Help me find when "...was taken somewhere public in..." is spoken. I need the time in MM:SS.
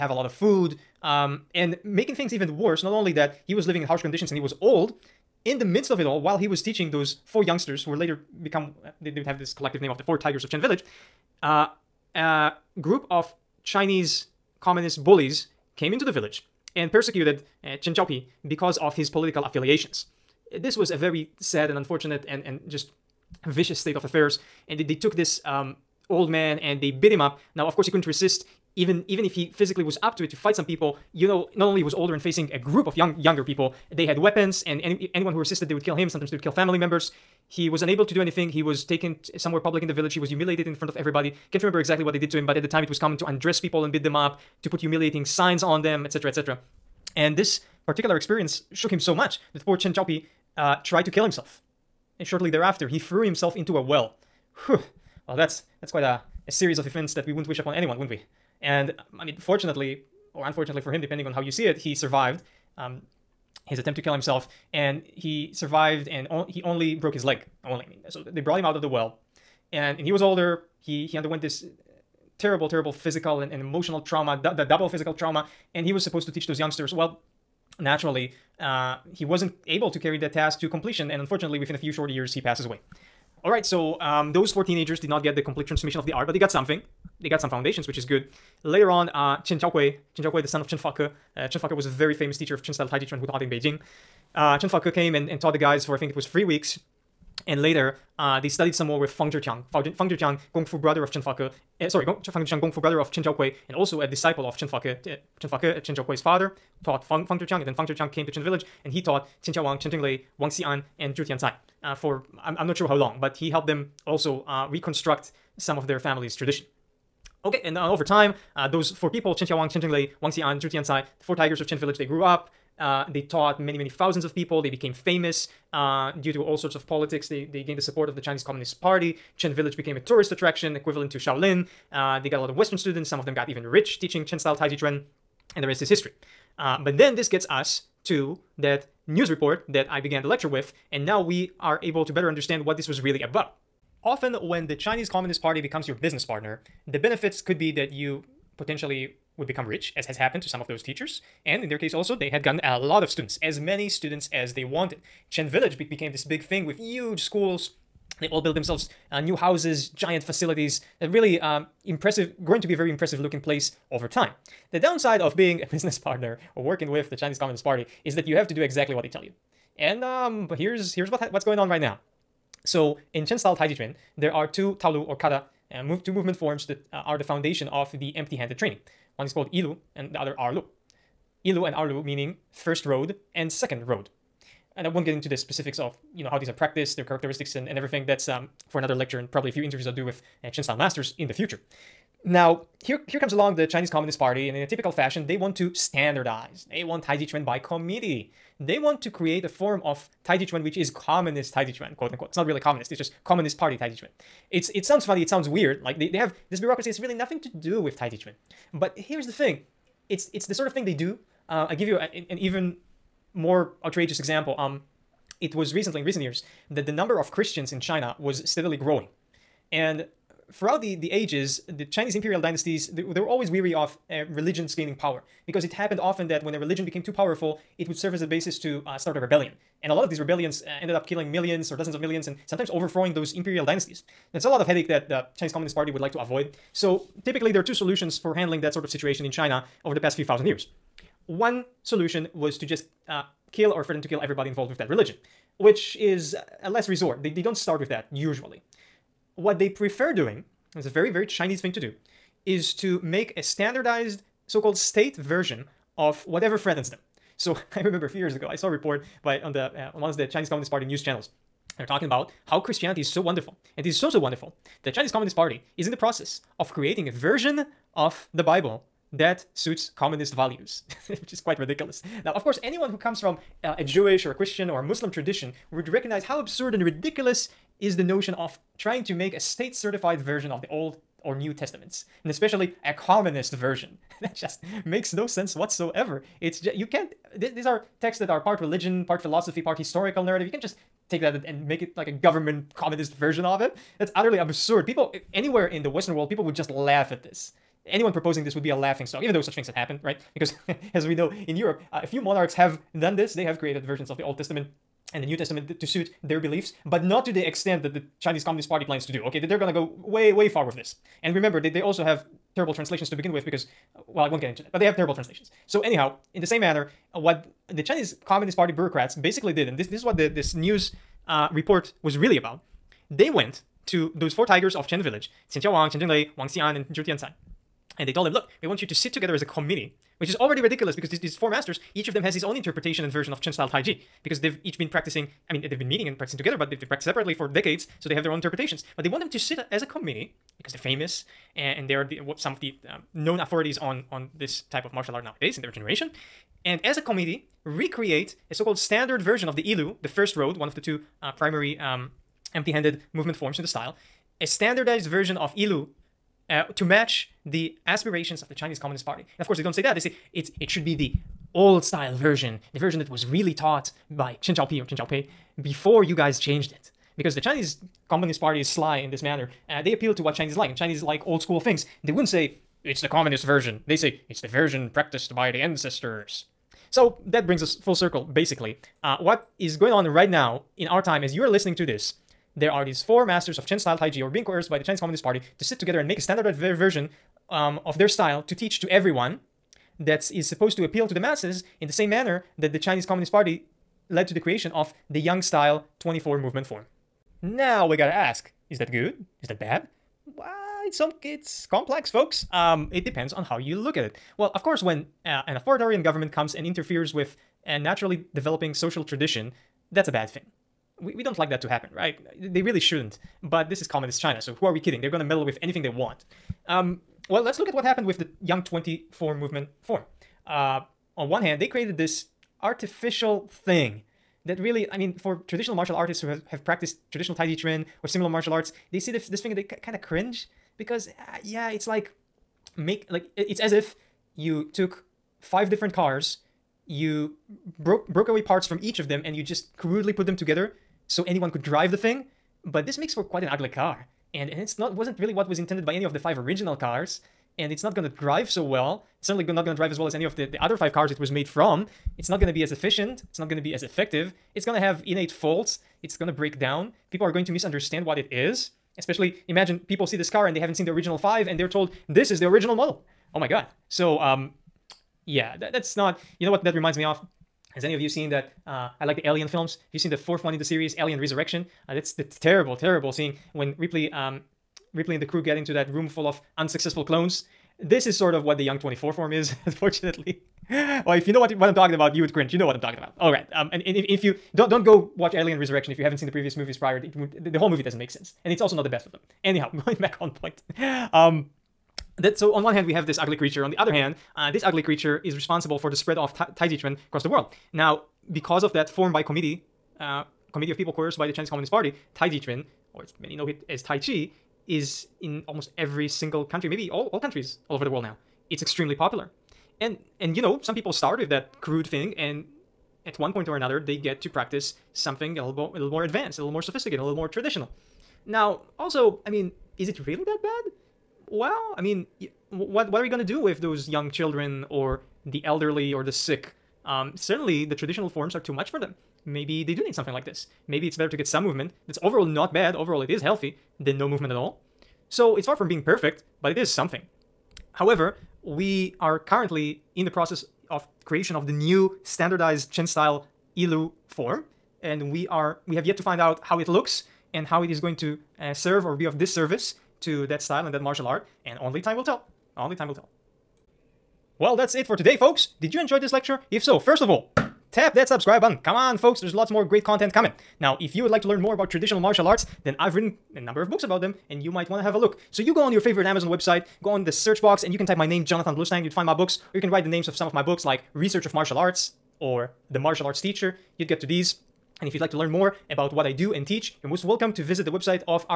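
00:38.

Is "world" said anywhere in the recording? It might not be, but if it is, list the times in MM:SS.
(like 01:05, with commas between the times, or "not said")
04:56, 08:17, 08:27.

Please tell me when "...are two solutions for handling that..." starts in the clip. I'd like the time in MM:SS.
03:57.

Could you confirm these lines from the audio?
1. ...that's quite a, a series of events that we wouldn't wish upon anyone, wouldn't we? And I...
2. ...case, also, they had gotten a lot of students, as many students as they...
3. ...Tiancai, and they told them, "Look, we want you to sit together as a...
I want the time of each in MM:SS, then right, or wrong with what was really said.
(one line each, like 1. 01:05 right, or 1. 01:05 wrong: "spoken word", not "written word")
1. 00:55 right
2. 02:31 right
3. 05:27 right.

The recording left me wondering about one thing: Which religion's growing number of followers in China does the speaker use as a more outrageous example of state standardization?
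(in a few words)
Christians.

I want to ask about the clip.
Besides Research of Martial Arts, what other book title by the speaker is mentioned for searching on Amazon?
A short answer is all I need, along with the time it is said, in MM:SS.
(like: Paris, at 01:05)
The Martial Arts Teacher, at 09:32.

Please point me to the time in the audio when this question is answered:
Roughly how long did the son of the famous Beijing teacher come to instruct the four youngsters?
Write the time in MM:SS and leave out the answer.
01:36.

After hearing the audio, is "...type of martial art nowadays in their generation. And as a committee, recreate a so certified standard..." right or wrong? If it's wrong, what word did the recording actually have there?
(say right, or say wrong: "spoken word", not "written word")
wrong: "called", not "certified".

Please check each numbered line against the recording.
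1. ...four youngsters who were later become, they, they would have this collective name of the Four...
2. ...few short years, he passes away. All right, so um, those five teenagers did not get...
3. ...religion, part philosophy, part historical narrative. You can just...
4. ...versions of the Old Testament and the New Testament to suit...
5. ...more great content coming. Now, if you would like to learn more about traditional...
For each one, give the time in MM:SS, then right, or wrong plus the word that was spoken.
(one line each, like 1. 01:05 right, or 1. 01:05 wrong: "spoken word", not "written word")
1. 00:07 right
2. 01:21 wrong: "four", not "five"
3. 04:48 right
4. 05:03 right
5. 09:19 right.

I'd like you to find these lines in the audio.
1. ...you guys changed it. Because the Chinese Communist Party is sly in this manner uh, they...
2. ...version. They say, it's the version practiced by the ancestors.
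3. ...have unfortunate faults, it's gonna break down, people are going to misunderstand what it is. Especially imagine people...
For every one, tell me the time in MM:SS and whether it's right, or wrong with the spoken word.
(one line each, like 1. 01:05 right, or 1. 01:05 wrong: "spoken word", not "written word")
1. 06:06 right
2. 06:13 right
3. 07:34 wrong: "innate", not "unfortunate".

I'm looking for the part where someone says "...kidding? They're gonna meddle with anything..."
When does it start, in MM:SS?
06:54.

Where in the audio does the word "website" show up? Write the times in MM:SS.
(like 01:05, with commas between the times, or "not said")
09:26, 09:37.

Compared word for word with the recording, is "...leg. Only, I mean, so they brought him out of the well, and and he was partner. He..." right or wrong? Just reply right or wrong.
wrong.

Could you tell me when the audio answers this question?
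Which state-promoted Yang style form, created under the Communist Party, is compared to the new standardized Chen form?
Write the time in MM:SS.
06:35.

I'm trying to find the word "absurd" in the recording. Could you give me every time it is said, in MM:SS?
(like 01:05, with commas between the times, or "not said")
04:36, 04:54.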